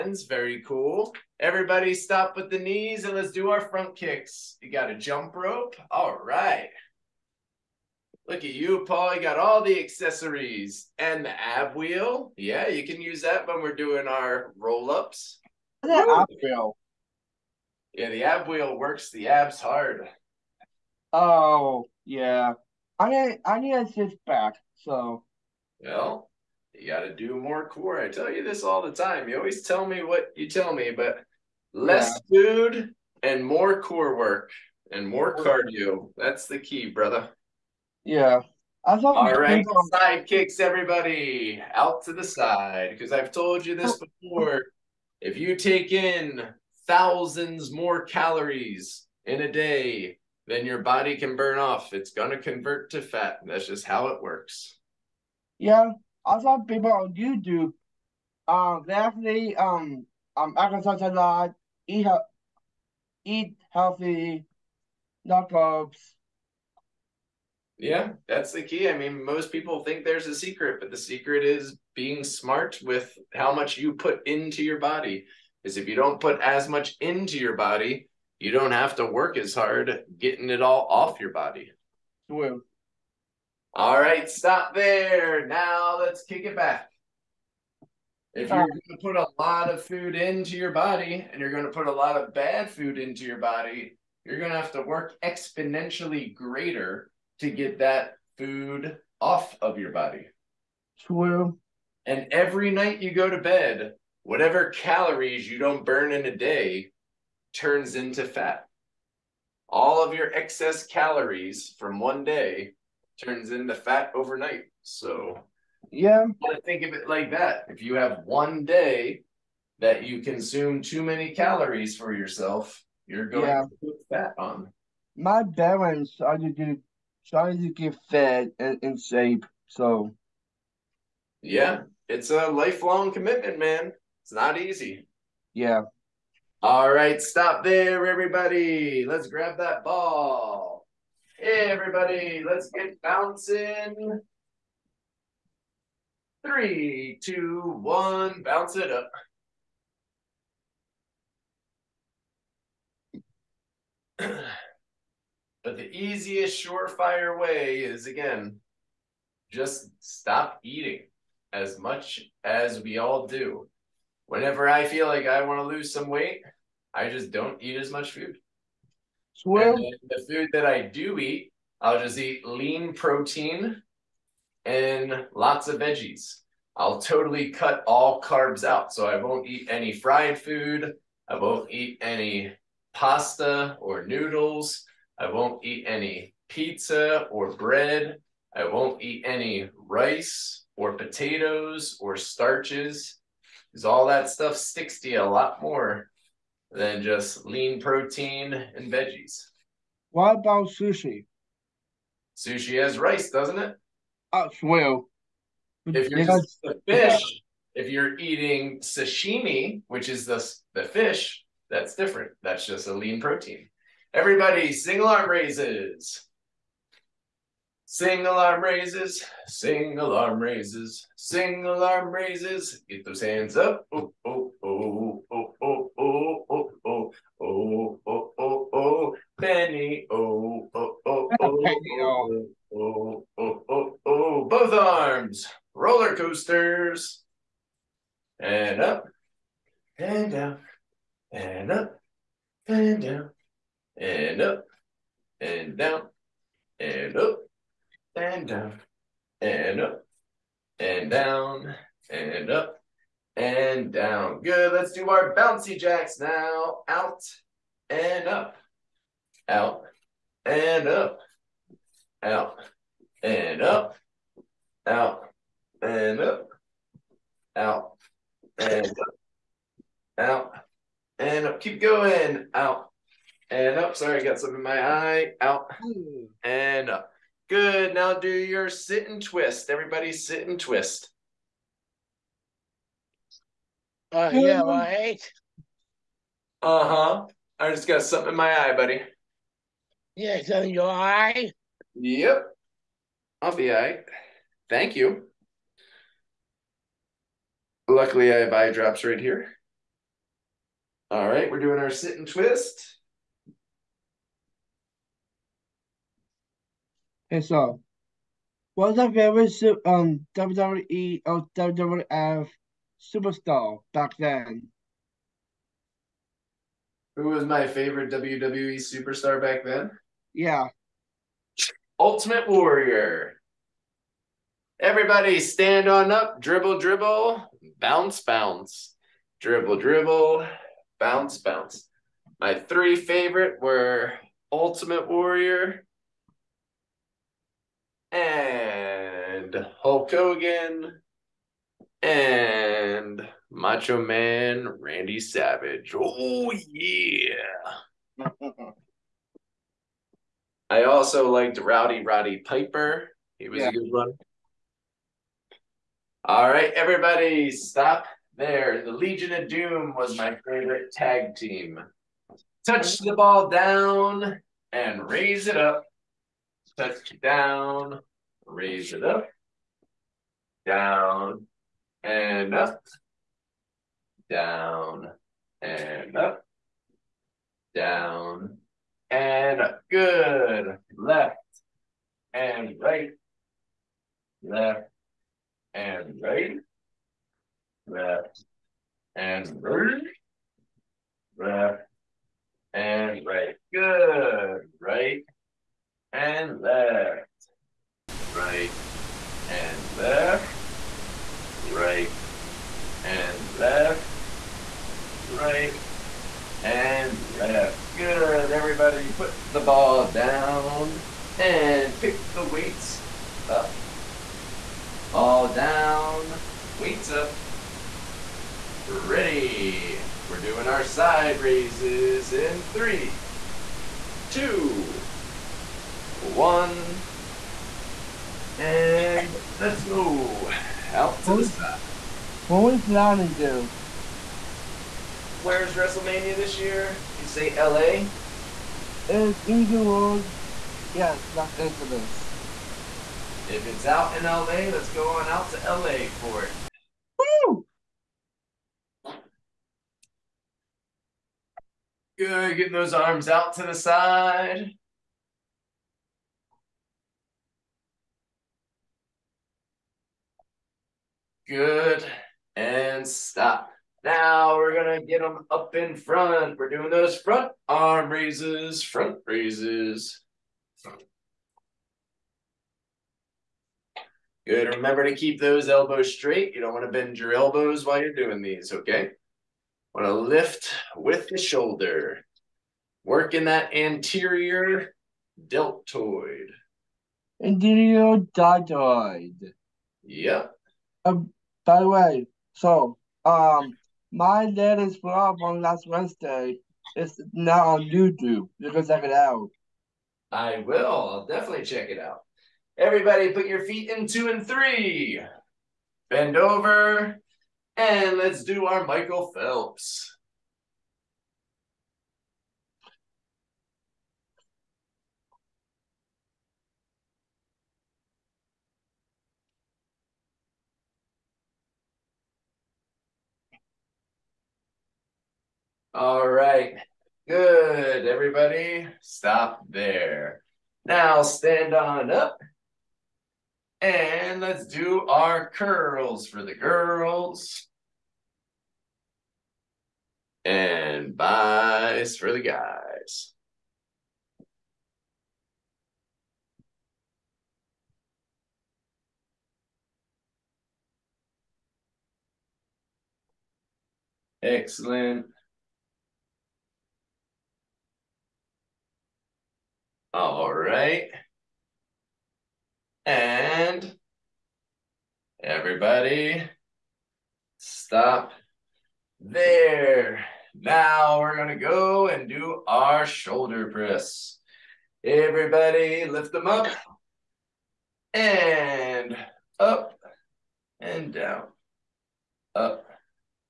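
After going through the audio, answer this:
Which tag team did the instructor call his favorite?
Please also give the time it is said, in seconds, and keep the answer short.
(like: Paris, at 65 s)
The Legion of Doom, at 358 s.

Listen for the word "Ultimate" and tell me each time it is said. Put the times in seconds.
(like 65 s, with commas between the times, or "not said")
322 s, 334 s.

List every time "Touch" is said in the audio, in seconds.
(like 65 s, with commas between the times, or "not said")
362 s, 366 s.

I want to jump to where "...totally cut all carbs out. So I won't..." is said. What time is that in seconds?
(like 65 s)
177 s.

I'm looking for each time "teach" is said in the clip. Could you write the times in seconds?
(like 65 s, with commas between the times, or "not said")
not said.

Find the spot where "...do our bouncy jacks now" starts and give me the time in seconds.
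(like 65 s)
254 s.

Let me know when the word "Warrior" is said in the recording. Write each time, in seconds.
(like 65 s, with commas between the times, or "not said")
322 s, 335 s.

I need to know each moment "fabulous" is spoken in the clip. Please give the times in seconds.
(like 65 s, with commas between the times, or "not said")
not said.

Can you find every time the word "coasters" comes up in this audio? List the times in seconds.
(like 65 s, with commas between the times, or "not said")
236 s.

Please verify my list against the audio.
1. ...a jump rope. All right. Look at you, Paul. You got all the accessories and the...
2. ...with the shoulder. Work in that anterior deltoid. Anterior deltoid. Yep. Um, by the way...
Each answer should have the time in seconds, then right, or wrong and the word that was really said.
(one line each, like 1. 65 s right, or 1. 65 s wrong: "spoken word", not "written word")
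1. 4 s right
2. 480 s right.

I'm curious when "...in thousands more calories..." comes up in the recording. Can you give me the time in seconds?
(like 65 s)
45 s.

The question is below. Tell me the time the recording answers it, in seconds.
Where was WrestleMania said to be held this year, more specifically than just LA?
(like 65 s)
439 s.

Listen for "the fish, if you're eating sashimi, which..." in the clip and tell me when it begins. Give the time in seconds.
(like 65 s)
206 s.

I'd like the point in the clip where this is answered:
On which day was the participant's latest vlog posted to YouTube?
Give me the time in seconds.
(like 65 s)
495 s.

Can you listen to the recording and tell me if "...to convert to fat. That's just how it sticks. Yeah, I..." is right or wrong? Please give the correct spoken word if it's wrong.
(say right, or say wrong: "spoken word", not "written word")
wrong: "works", not "sticks".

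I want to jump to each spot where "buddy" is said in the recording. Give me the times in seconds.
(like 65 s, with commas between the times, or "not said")
288 s.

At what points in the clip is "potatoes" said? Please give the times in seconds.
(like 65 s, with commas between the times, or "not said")
190 s.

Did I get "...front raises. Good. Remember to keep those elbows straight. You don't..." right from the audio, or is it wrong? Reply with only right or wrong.
right.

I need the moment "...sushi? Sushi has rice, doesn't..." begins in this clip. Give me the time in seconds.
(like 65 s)
200 s.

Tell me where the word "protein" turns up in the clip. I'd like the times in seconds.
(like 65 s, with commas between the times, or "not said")
172 s, 197 s, 213 s.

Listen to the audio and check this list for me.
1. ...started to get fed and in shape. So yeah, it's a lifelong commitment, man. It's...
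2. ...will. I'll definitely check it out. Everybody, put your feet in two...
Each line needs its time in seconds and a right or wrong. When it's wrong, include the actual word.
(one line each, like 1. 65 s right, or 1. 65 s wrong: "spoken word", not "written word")
1. 127 s right
2. 500 s right.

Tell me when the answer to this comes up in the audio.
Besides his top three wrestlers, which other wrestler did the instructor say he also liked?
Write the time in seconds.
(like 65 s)
351 s.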